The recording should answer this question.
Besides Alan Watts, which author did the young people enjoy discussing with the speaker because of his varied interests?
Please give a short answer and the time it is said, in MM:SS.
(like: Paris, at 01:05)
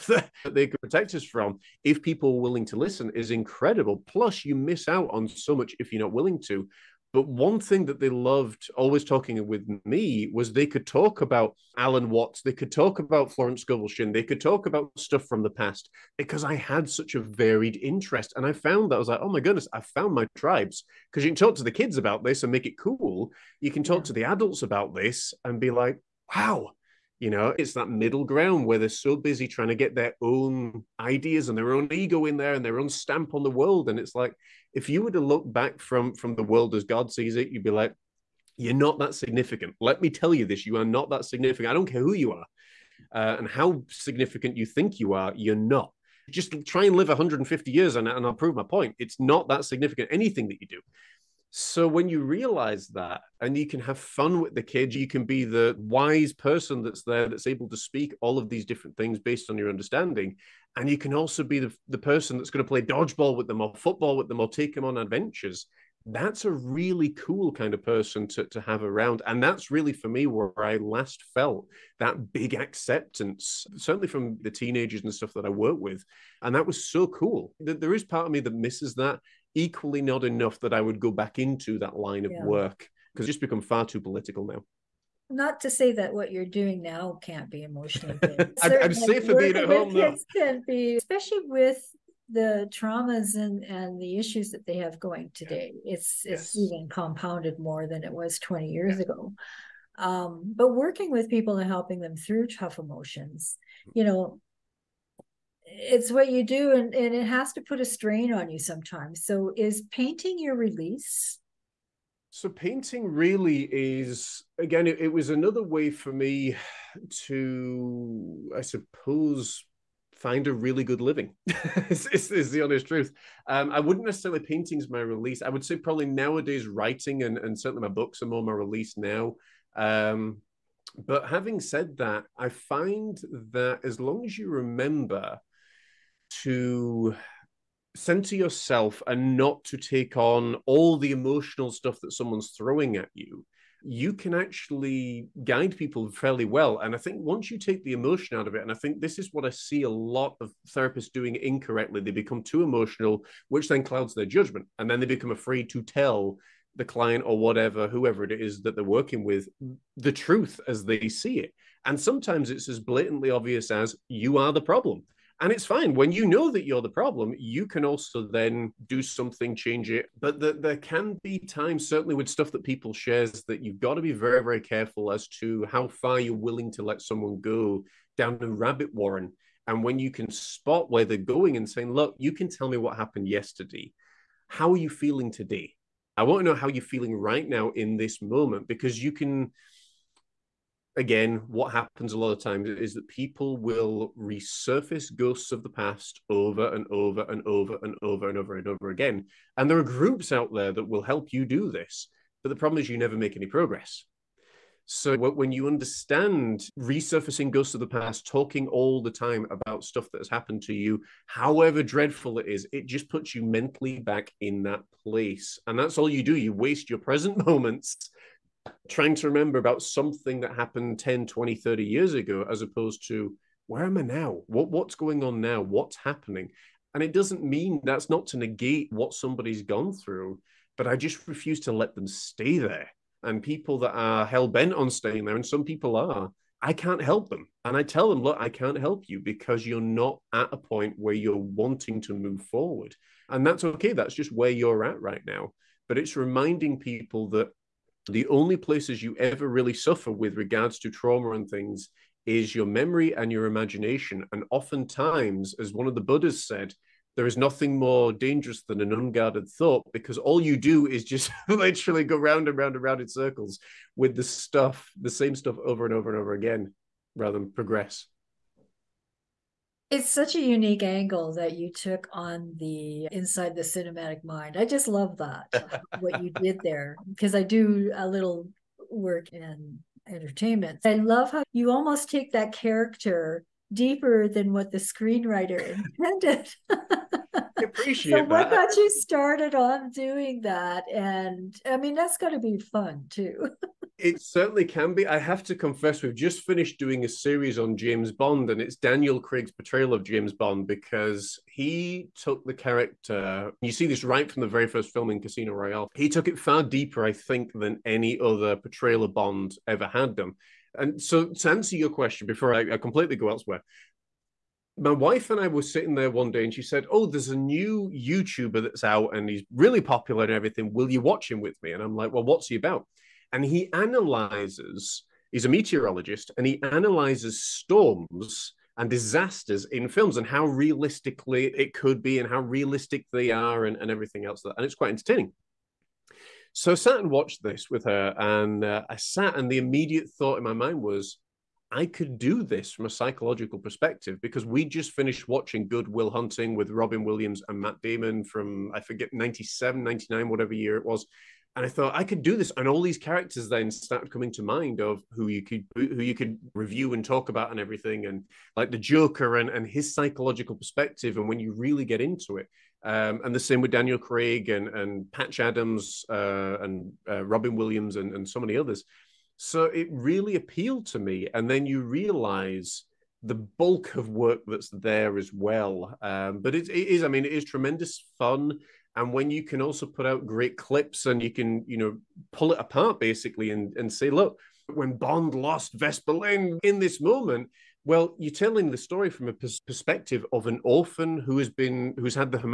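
Florence Scovel Shinn, at 00:13.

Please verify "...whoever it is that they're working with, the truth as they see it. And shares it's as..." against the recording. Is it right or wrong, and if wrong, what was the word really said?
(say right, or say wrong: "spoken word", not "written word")
wrong: "sometimes", not "shares".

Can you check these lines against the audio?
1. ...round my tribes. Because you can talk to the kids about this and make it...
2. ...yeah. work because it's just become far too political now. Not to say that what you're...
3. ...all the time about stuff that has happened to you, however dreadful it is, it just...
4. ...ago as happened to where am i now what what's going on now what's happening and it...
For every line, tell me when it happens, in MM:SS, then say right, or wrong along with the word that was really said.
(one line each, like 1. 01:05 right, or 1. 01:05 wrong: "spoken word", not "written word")
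1. 00:19 wrong: "found", not "round"
2. 01:22 right
3. 03:28 right
4. 03:42 wrong: "opposed", not "happened".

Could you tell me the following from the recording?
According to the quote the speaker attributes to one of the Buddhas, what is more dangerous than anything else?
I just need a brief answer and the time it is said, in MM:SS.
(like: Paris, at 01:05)
an unguarded thought, at 04:18.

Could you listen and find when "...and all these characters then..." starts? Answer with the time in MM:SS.
05:52.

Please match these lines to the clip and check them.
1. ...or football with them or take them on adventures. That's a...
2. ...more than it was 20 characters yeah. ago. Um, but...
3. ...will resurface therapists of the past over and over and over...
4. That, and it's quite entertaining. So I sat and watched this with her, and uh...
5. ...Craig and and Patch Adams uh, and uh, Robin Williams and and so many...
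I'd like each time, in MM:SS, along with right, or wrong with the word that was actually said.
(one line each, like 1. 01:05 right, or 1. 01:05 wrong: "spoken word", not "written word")
1. 01:03 right
2. 01:37 wrong: "years", not "characters"
3. 03:13 wrong: "ghosts", not "therapists"
4. 05:34 right
5. 06:03 right.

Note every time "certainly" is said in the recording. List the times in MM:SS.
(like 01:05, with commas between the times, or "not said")
01:13, 02:07, 02:51, 04:54.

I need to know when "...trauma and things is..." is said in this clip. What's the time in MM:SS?
04:10.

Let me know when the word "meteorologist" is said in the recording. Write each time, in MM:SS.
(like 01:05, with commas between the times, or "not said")
05:25.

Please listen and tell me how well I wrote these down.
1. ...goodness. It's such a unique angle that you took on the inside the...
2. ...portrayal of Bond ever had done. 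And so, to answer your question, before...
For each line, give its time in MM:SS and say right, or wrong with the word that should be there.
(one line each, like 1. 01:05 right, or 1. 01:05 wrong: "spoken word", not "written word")
1. 04:27 wrong: "progress", not "goodness"
2. 05:08 right.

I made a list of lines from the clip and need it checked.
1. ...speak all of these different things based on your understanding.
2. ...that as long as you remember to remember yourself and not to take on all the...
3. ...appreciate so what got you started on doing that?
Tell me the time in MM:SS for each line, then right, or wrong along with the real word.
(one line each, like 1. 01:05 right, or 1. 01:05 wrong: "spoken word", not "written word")
1. 00:57 right
2. 02:13 wrong: "center", not "remember"
3. 04:47 right.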